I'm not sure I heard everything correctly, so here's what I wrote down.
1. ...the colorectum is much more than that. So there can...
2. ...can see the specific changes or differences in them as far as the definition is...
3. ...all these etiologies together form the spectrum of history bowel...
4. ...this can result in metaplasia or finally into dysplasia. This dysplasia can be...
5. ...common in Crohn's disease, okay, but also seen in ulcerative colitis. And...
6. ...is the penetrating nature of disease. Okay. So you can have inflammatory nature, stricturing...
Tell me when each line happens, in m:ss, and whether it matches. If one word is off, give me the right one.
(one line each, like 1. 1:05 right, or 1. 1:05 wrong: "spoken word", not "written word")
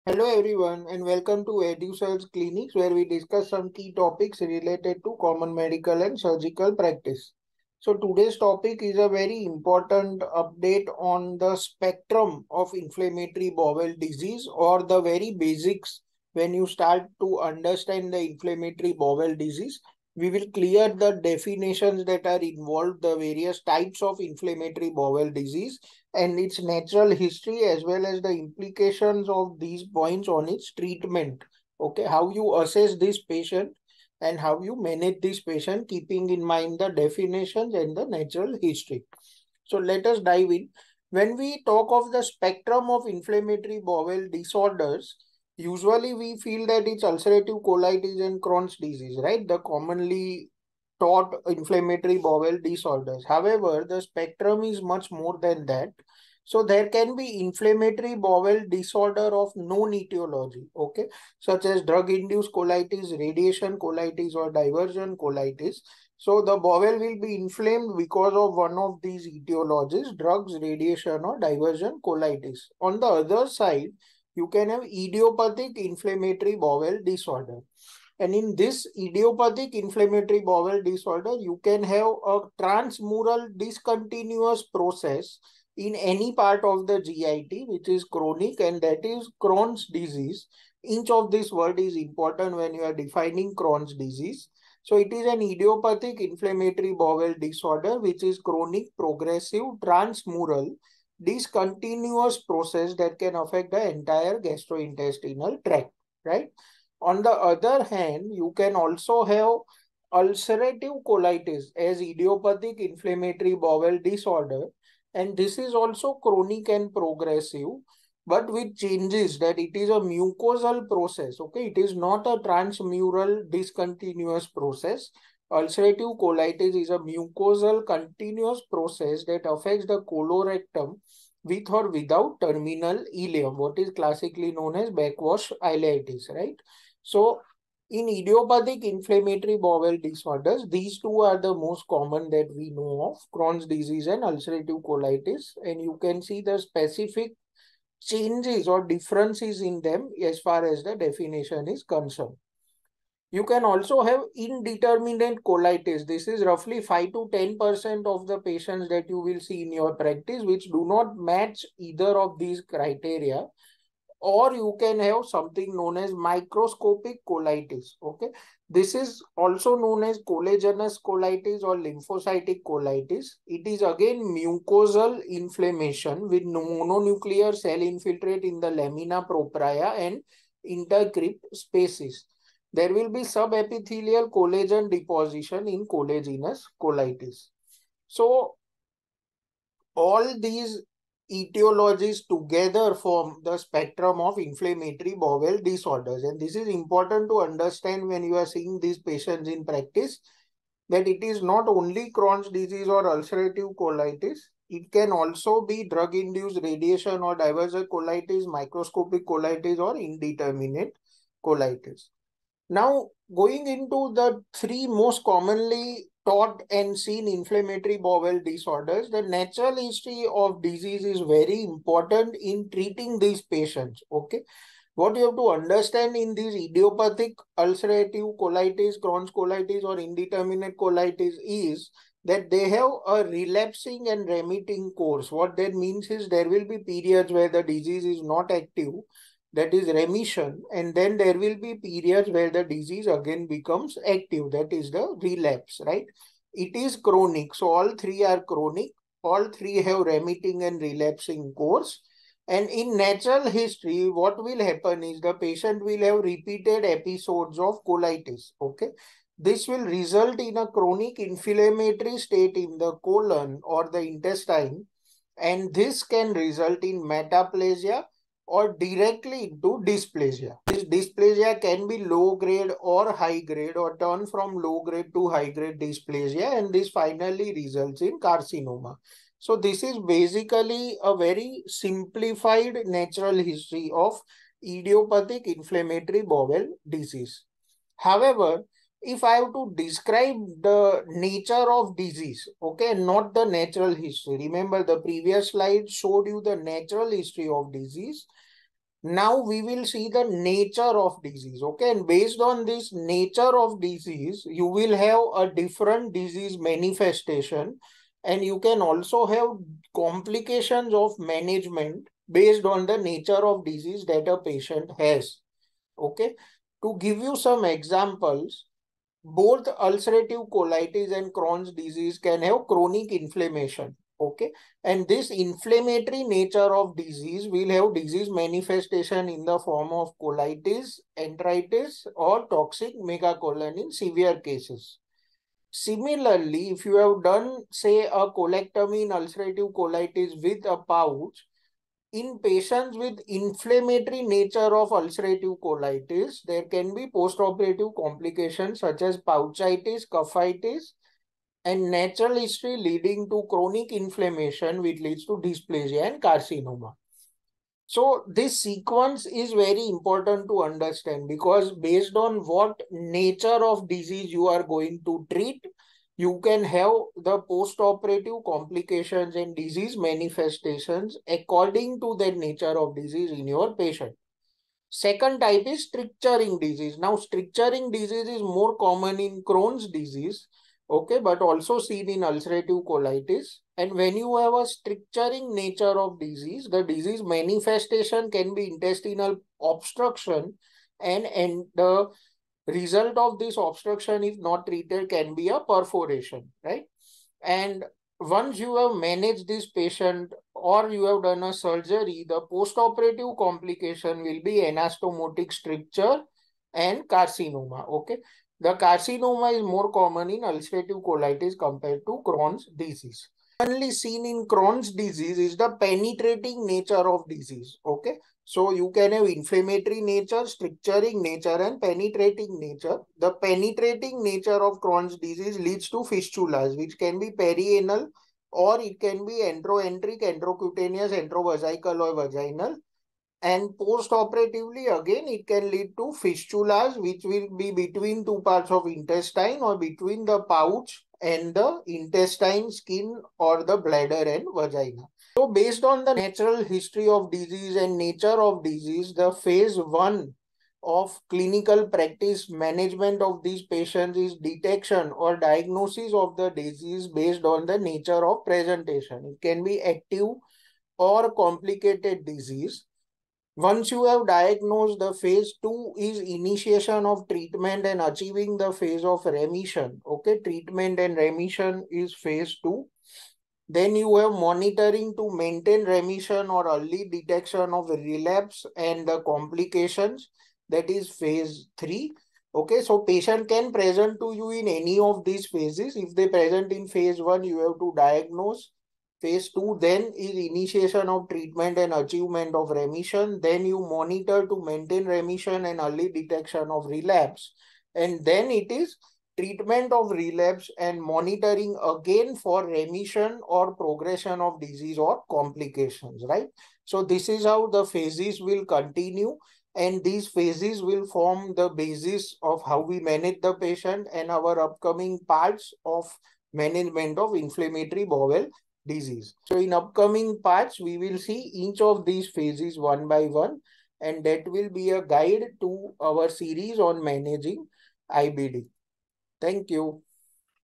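1. 0:53 wrong: "spectrum", not "colorectum"
2. 2:26 right
3. 3:09 wrong: "inflammatory", not "history"
4. 4:25 wrong: "directly", not "finally"
5. 6:18 right
6. 6:55 right.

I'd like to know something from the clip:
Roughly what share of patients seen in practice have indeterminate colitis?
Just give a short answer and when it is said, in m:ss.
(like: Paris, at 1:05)
5 to 10%, at 2:36.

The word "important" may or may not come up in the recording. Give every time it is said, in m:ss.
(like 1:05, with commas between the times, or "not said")
0:09, 1:31, 3:16, 3:41, 5:59.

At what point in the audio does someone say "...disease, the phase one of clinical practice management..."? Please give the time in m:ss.
7:28.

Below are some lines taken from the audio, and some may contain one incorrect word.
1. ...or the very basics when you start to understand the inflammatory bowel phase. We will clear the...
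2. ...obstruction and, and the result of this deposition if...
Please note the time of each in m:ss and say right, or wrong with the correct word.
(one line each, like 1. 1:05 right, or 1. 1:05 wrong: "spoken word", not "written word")
1. 0:14 wrong: "disease", not "phase"
2. 6:29 wrong: "obstruction", not "deposition".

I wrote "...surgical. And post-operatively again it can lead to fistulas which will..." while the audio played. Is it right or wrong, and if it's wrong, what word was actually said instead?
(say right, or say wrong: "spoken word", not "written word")
wrong: "vaginal", not "surgical".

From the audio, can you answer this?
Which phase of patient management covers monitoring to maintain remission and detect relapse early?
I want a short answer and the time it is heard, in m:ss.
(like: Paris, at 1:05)
Phase 3, at 8:01.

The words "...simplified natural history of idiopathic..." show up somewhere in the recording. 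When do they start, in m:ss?
4:41.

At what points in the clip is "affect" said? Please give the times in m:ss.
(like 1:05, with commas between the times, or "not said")
1:43, 2:09.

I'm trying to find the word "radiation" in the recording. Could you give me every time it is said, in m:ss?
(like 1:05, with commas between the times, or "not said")
1:03, 1:10, 3:26.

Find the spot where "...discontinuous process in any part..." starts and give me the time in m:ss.
1:23.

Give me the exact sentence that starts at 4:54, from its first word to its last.
Remember the previous slide showed you the natural history of disease.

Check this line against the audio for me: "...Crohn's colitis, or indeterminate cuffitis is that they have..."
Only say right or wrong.
wrong.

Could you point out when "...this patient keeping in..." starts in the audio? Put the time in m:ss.
0:35.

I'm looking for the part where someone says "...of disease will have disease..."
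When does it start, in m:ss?
5:26.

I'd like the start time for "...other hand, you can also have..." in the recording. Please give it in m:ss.
1:47.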